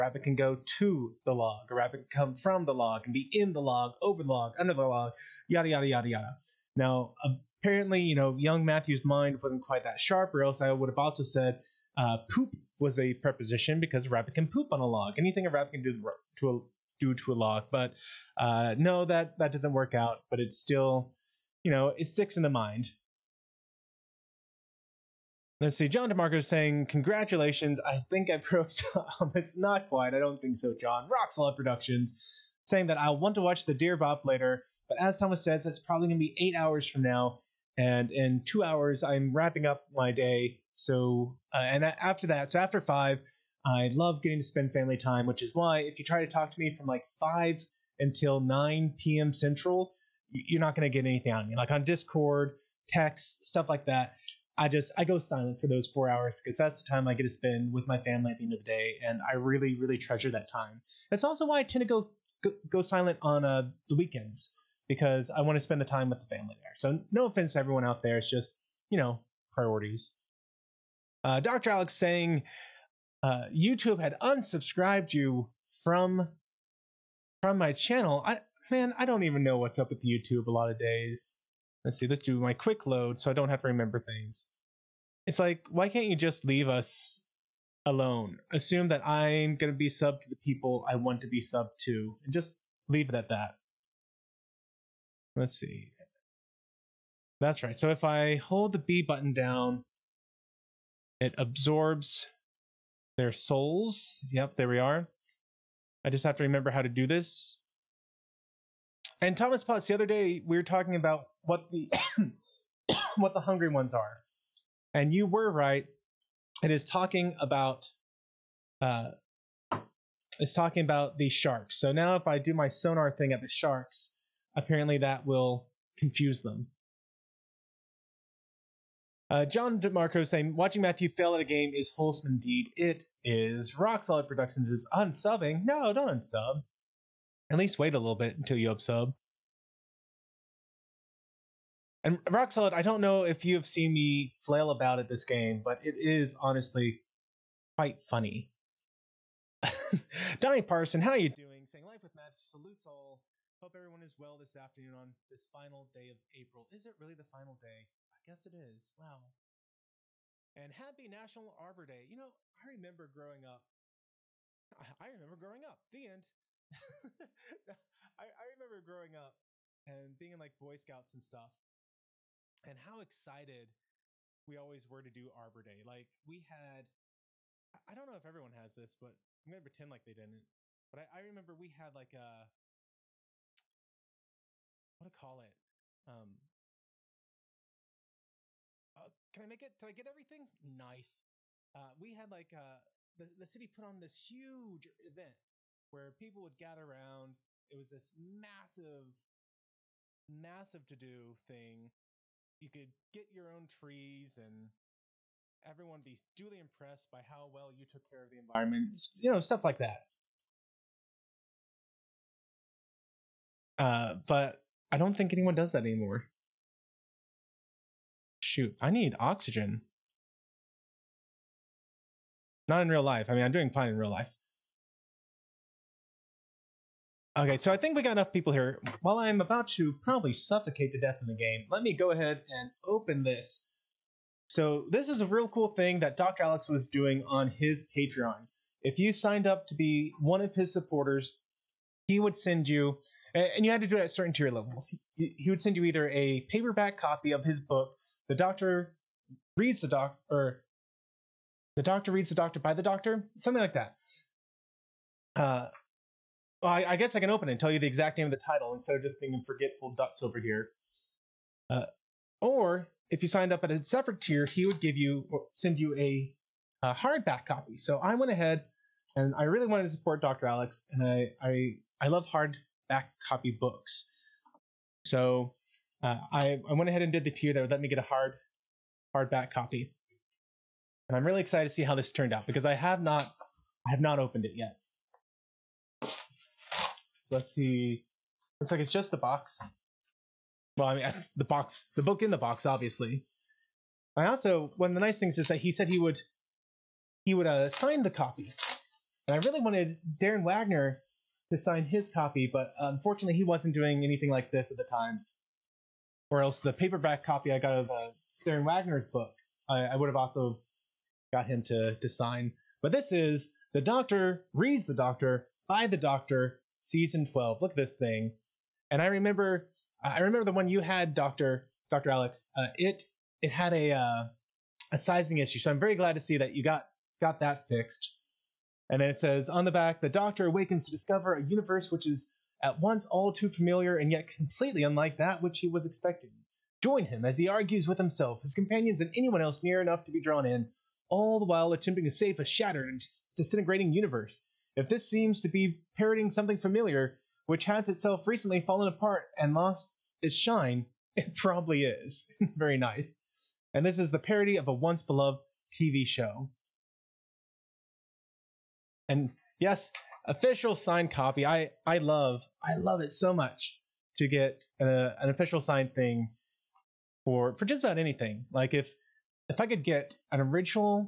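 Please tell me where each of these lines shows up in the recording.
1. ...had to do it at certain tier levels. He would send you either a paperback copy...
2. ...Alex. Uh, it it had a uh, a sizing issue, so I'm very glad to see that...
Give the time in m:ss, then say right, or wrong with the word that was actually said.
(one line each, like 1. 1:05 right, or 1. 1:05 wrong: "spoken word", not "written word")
1. 4:03 right
2. 5:22 right.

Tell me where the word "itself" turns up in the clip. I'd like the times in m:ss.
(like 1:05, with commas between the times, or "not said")
5:47.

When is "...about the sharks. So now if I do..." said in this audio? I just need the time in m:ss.
2:00.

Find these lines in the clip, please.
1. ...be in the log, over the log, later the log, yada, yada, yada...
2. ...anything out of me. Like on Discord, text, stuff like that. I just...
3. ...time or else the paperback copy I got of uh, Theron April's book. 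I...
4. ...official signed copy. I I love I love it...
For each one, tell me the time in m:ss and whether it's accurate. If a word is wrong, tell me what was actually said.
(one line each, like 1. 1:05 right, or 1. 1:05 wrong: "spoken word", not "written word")
1. 0:03 wrong: "under", not "later"
2. 0:51 right
3. 5:04 wrong: "Wagner", not "April"
4. 6:00 right.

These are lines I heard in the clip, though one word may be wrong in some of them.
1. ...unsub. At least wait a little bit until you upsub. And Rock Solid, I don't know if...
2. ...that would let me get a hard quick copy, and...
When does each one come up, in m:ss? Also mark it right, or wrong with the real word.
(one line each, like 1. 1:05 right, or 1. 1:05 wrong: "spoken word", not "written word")
1. 2:16 right
2. 4:37 wrong: "hardback", not "quick".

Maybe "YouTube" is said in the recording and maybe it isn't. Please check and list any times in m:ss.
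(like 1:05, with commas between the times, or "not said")
1:13, 1:20.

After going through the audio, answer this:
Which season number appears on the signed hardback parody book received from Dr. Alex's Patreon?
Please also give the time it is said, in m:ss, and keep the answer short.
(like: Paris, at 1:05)
12, at 5:16.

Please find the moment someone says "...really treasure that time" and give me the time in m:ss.
0:59.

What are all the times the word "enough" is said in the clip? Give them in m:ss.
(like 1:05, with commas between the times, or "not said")
3:48, 5:39.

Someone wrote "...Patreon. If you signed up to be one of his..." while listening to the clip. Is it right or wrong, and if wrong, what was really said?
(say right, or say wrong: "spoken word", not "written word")
right.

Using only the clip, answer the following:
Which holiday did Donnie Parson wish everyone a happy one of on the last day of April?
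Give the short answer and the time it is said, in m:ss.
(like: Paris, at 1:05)
National Arbor Day, at 2:41.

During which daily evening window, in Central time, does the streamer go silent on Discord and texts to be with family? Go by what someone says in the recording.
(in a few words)
5 to 9 p.m.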